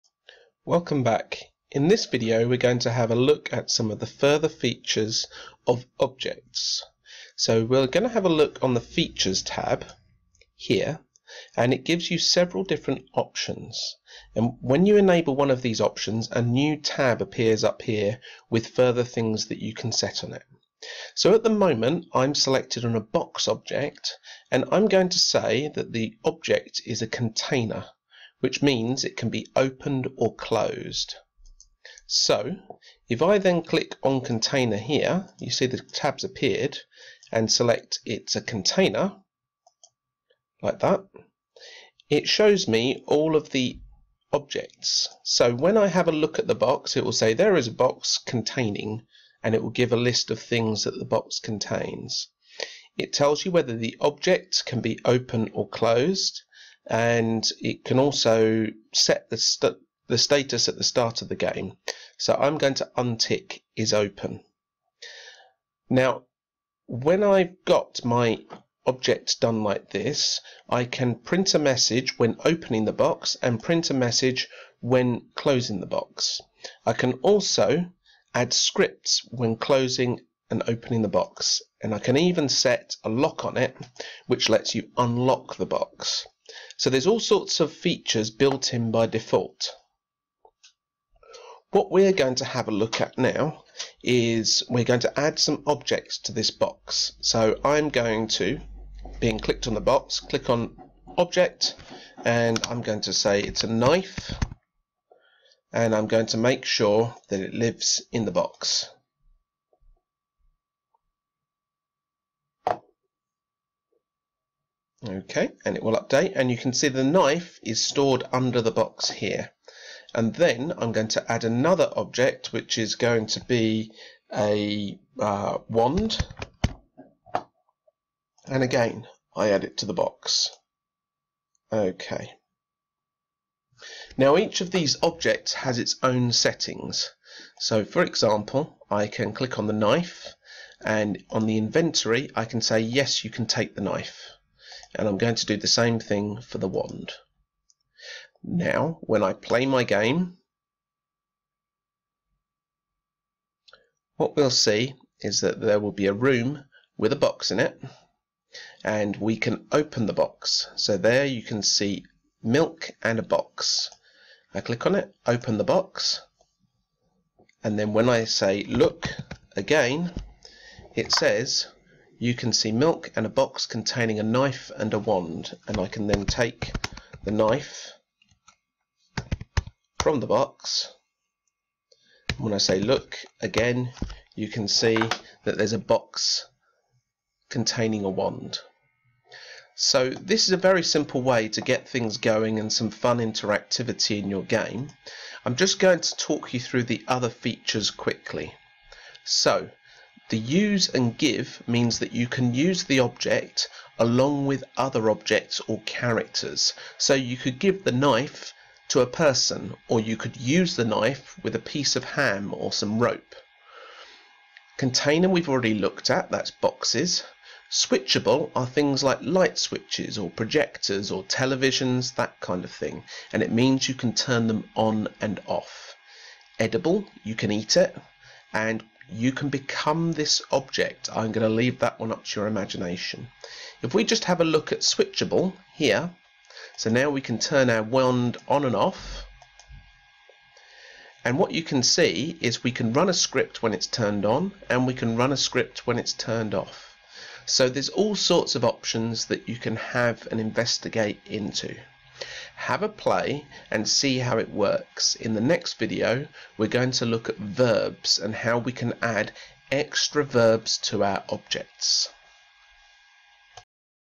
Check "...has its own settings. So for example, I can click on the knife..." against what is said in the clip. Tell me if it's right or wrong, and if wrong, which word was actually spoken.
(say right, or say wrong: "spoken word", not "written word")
right.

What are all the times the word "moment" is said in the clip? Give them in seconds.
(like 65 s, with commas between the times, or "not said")
21 s.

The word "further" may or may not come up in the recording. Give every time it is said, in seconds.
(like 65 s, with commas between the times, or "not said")
4 s, 18 s.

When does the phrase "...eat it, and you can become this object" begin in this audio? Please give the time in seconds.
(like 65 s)
227 s.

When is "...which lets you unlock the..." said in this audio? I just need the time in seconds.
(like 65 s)
84 s.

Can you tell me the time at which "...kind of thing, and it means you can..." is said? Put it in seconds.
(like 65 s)
222 s.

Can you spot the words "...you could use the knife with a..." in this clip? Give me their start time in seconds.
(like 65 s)
209 s.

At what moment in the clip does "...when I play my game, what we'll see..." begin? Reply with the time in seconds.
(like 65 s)
149 s.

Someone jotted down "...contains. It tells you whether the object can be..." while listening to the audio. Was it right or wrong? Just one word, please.
right.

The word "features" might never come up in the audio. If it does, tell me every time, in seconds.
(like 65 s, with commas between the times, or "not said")
4 s, 8 s, 87 s, 197 s.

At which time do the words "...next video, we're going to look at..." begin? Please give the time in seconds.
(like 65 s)
255 s.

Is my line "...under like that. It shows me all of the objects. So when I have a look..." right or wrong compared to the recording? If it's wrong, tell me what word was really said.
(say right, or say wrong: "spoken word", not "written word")
wrong: "container", not "under".